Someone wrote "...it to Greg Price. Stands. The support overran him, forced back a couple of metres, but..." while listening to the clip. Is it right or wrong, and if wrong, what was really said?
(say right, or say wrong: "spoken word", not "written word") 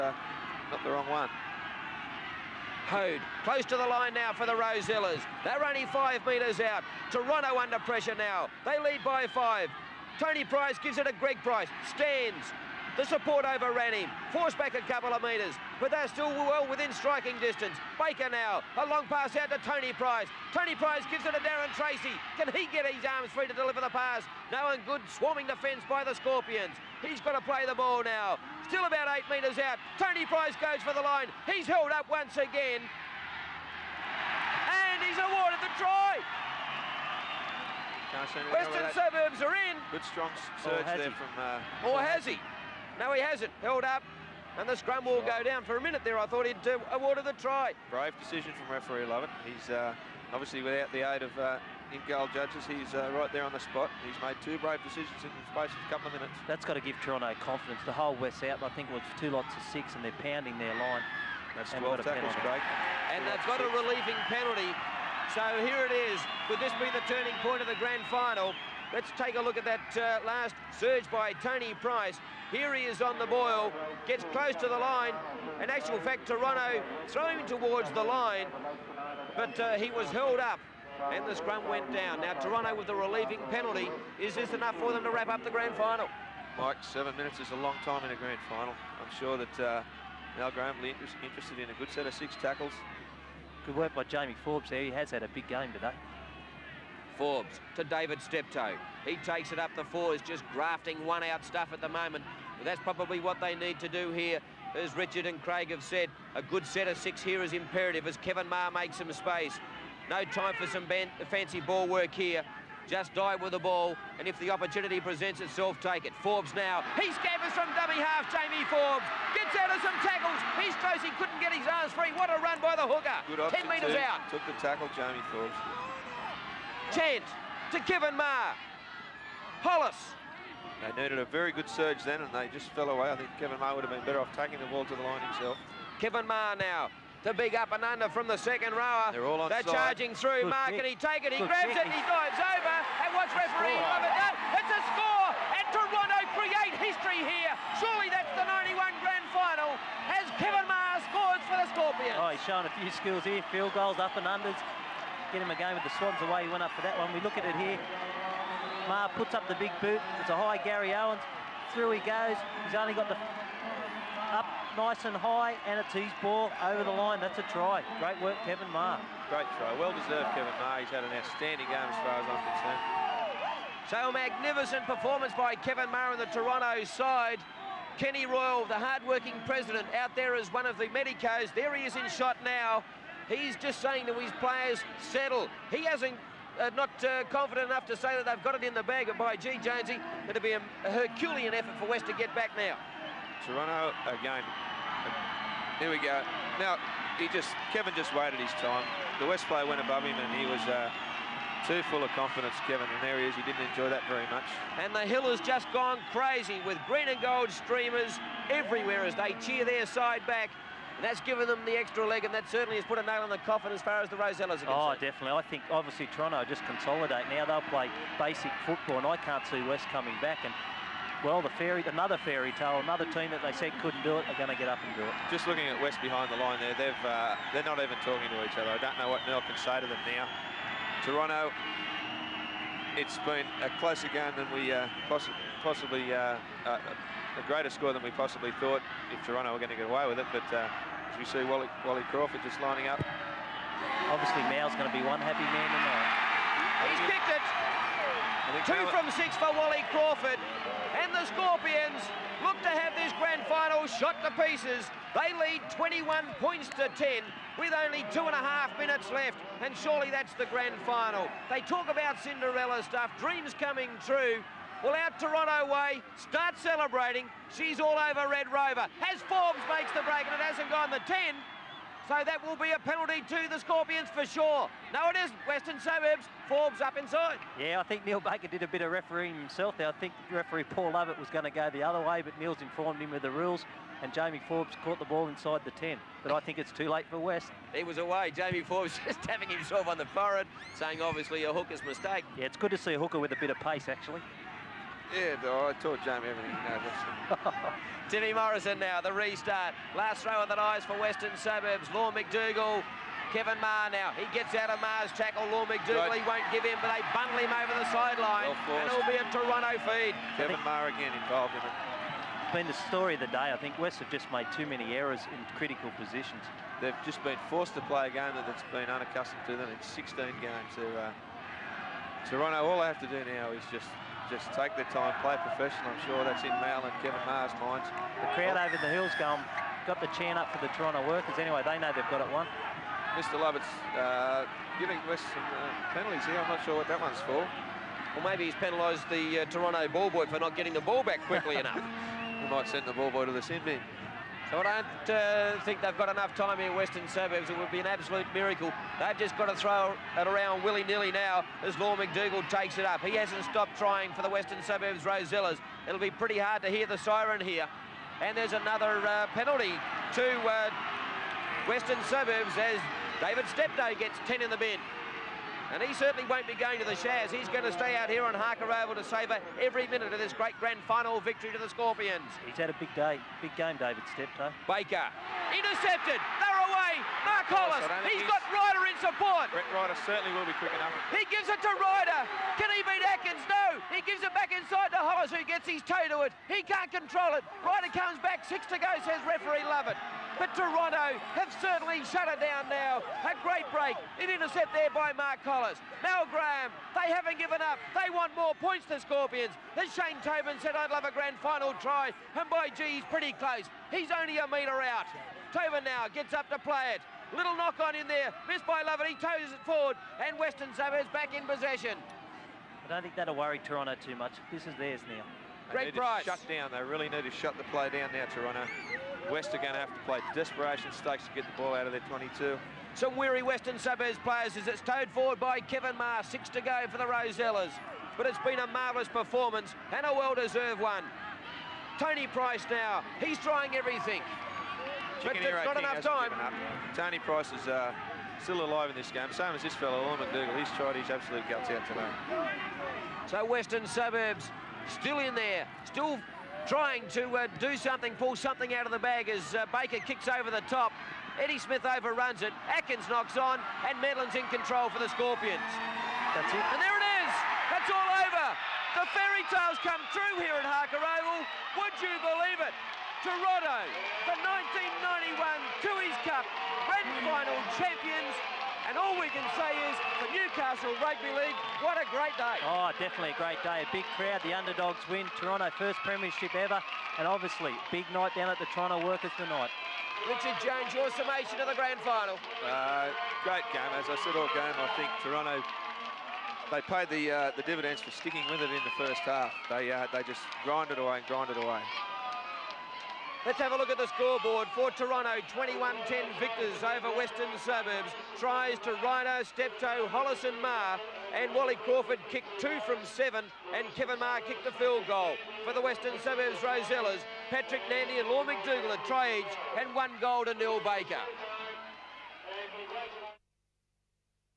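right.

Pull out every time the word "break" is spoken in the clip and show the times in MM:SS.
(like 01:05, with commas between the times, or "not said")
04:30, 06:33.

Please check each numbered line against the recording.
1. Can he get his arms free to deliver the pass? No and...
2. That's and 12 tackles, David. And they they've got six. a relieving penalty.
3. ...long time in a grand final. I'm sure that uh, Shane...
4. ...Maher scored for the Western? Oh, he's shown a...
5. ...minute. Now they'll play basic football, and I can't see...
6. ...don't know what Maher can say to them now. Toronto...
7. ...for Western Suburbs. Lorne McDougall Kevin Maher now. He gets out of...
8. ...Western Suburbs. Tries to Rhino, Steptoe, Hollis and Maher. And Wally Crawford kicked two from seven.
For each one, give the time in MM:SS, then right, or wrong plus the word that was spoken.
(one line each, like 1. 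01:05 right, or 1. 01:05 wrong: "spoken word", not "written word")
1. 00:22 right
2. 01:01 wrong: "Craig", not "David"
3. 01:27 wrong: "Mal", not "Shane"
4. 02:30 wrong: "Scorpions", not "Western"
5. 03:36 wrong: "consolidate", not "minute"
6. 03:48 wrong: "Neil", not "Maher"
7. 05:00 right
8. 08:17 right.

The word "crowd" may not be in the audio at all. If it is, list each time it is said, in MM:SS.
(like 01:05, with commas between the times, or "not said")
05:28, 07:54.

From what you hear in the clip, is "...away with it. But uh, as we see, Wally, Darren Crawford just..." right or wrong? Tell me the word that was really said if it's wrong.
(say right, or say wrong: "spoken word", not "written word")
wrong: "Wally", not "Darren".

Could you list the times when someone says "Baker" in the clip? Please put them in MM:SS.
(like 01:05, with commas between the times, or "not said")
00:18, 04:38, 06:14, 07:29, 08:30.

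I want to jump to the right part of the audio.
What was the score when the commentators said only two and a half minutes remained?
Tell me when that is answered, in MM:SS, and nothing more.
04:15.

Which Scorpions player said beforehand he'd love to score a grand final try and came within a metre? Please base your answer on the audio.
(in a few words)
Shane Tobin.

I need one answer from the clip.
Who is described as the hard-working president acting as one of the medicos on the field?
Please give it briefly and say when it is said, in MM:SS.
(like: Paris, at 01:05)
Kenny Royal, at 02:57.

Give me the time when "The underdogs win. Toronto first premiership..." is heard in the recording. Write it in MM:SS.
07:54.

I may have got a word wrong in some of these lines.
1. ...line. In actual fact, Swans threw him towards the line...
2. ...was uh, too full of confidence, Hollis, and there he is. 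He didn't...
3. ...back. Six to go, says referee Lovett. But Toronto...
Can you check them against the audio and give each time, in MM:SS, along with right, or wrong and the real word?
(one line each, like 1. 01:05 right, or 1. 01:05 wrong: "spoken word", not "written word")
1. 01:14 wrong: "Toronto", not "Swans"
2. 03:20 wrong: "Kevin", not "Hollis"
3. 06:28 right.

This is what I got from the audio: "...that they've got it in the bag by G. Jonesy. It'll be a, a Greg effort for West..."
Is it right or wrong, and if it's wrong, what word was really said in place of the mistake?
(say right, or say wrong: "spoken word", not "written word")
wrong: "Herculean", not "Greg".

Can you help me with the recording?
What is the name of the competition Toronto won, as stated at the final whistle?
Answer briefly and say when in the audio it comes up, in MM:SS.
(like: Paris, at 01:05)
Tooheys Cup, at 07:45.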